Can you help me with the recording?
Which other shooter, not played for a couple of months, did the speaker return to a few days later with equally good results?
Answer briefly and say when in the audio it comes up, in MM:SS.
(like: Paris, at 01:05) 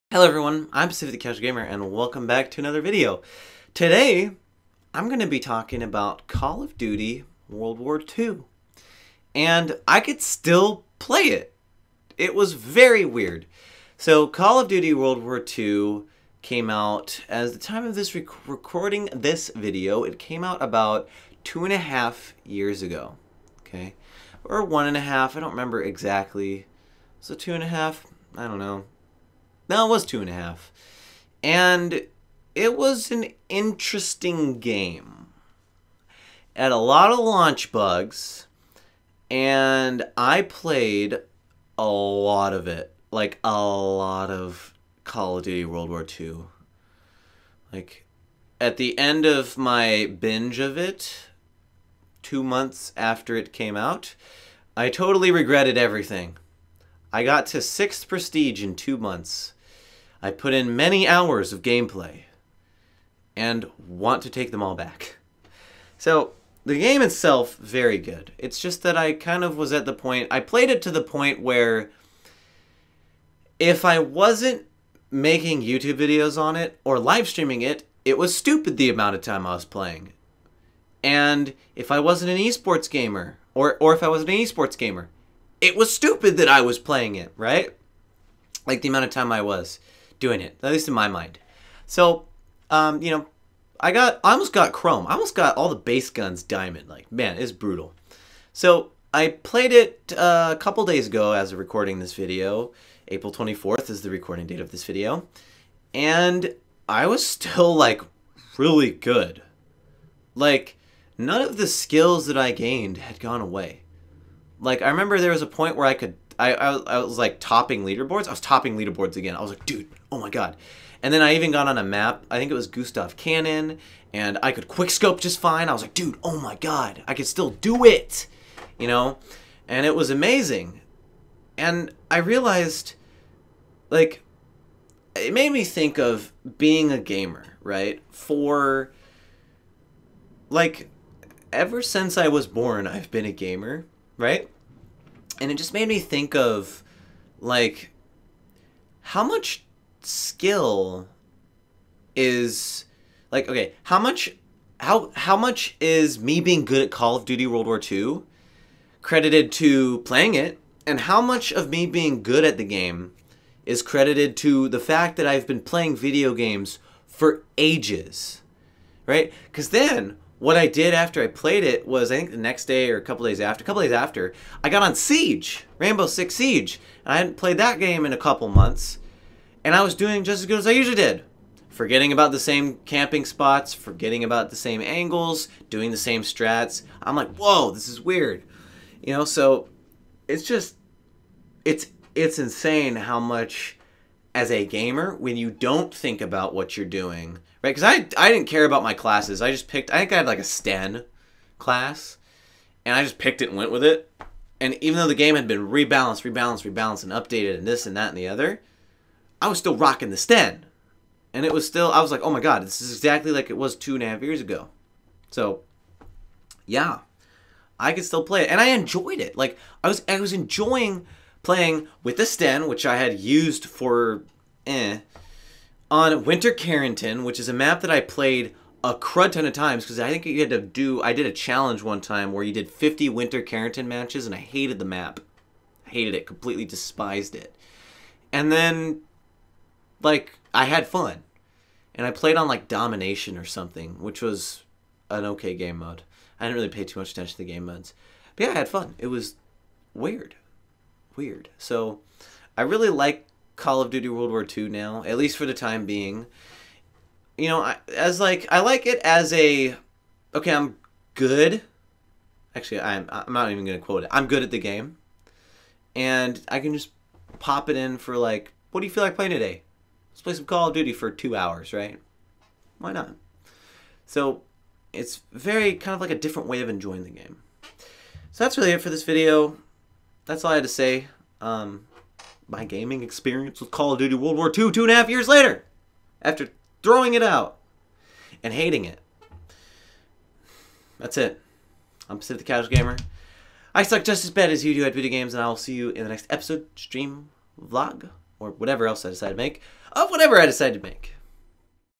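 Rainbow Six Siege, at 02:55.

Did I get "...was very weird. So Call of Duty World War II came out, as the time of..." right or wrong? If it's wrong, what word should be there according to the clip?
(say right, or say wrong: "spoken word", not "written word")
right.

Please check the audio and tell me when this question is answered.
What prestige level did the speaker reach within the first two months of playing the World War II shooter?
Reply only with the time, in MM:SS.
00:57.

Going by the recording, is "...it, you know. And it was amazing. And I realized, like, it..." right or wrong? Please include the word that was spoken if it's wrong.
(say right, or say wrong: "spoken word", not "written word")
right.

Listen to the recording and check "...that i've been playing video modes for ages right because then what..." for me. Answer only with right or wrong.
wrong.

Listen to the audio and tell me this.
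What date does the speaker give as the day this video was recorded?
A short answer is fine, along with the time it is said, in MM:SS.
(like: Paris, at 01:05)
April 24th, at 01:43.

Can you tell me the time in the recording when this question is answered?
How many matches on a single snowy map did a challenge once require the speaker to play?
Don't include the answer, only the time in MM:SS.
03:52.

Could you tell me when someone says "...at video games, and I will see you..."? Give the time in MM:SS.
04:54.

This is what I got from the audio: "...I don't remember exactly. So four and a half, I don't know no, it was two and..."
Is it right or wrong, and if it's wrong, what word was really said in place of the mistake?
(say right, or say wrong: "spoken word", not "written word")
wrong: "two", not "four".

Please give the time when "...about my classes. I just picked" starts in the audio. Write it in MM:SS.
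03:18.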